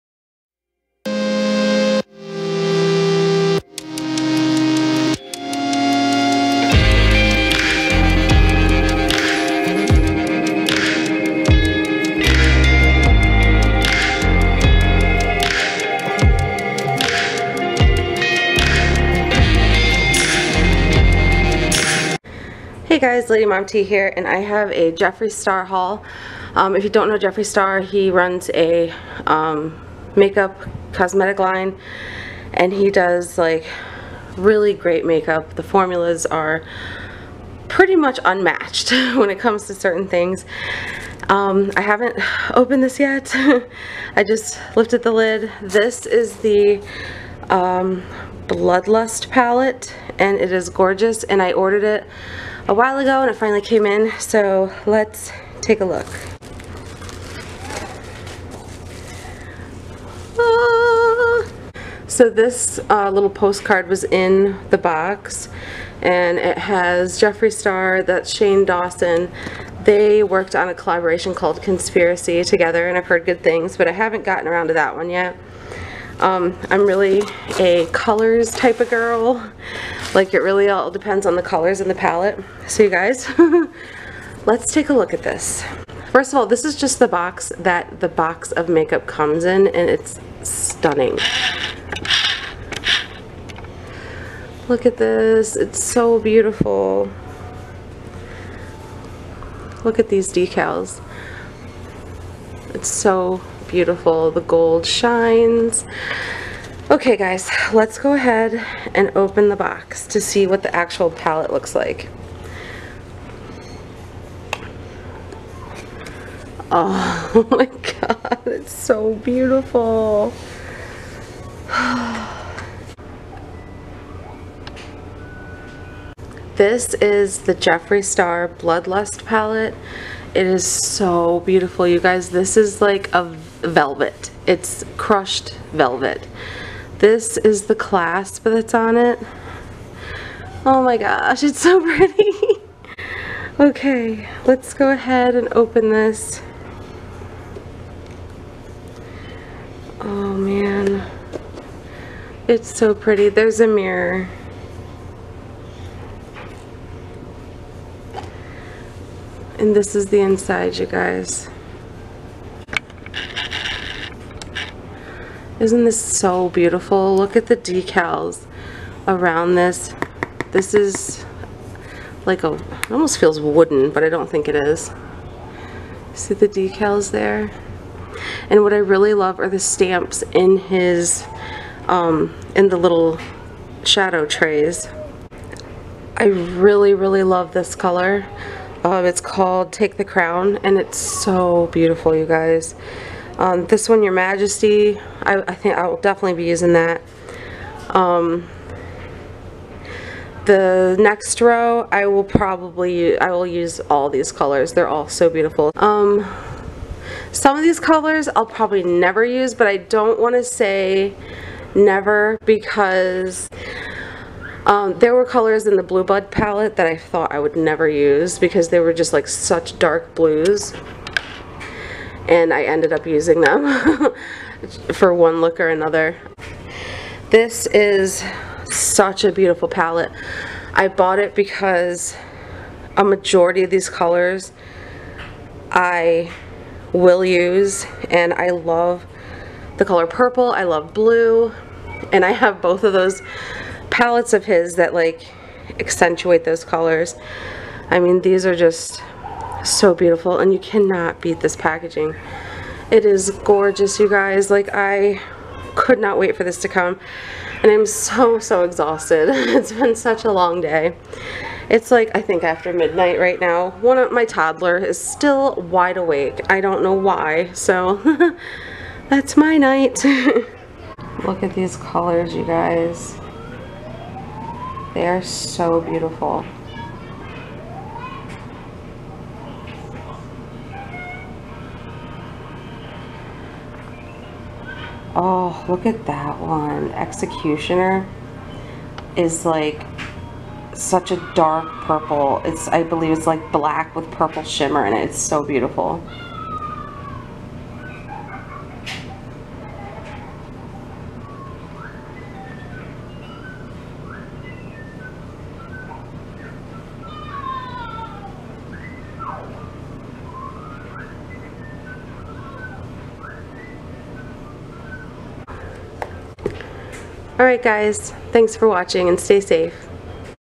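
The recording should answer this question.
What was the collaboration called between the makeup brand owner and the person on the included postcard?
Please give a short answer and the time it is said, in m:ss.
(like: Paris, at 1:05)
Conspiracy, at 1:11.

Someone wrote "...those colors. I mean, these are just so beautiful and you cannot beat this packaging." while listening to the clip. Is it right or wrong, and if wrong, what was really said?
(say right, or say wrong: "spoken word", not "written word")
right.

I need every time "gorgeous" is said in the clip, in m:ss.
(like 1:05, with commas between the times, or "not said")
0:50, 4:13.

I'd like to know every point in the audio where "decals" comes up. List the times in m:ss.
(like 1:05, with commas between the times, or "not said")
1:40, 2:47, 2:56.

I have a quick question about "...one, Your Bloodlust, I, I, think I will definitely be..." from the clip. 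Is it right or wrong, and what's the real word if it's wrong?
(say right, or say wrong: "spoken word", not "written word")
wrong: "Majesty", not "Bloodlust".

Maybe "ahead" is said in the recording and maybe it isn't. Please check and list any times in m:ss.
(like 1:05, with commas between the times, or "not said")
1:48, 2:24.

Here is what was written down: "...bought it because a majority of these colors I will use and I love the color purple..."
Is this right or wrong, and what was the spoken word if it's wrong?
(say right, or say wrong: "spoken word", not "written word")
right.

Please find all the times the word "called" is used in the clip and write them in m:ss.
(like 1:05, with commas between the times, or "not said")
1:11, 3:09.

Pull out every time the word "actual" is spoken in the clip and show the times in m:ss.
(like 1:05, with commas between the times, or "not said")
1:50.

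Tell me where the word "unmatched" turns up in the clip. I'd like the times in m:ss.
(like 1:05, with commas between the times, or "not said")
0:38.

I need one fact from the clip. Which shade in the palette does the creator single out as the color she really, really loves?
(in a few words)
Take the Crown.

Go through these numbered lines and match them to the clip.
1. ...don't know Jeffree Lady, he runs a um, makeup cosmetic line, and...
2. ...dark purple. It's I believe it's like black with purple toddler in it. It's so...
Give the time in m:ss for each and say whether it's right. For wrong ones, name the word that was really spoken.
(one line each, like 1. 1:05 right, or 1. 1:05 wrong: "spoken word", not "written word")
1. 0:26 wrong: "Star", not "Lady"
2. 4:51 wrong: "shimmer", not "toddler".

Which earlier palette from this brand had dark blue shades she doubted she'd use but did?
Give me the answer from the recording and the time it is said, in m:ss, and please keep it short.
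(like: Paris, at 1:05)
Blue Blood, at 3:35.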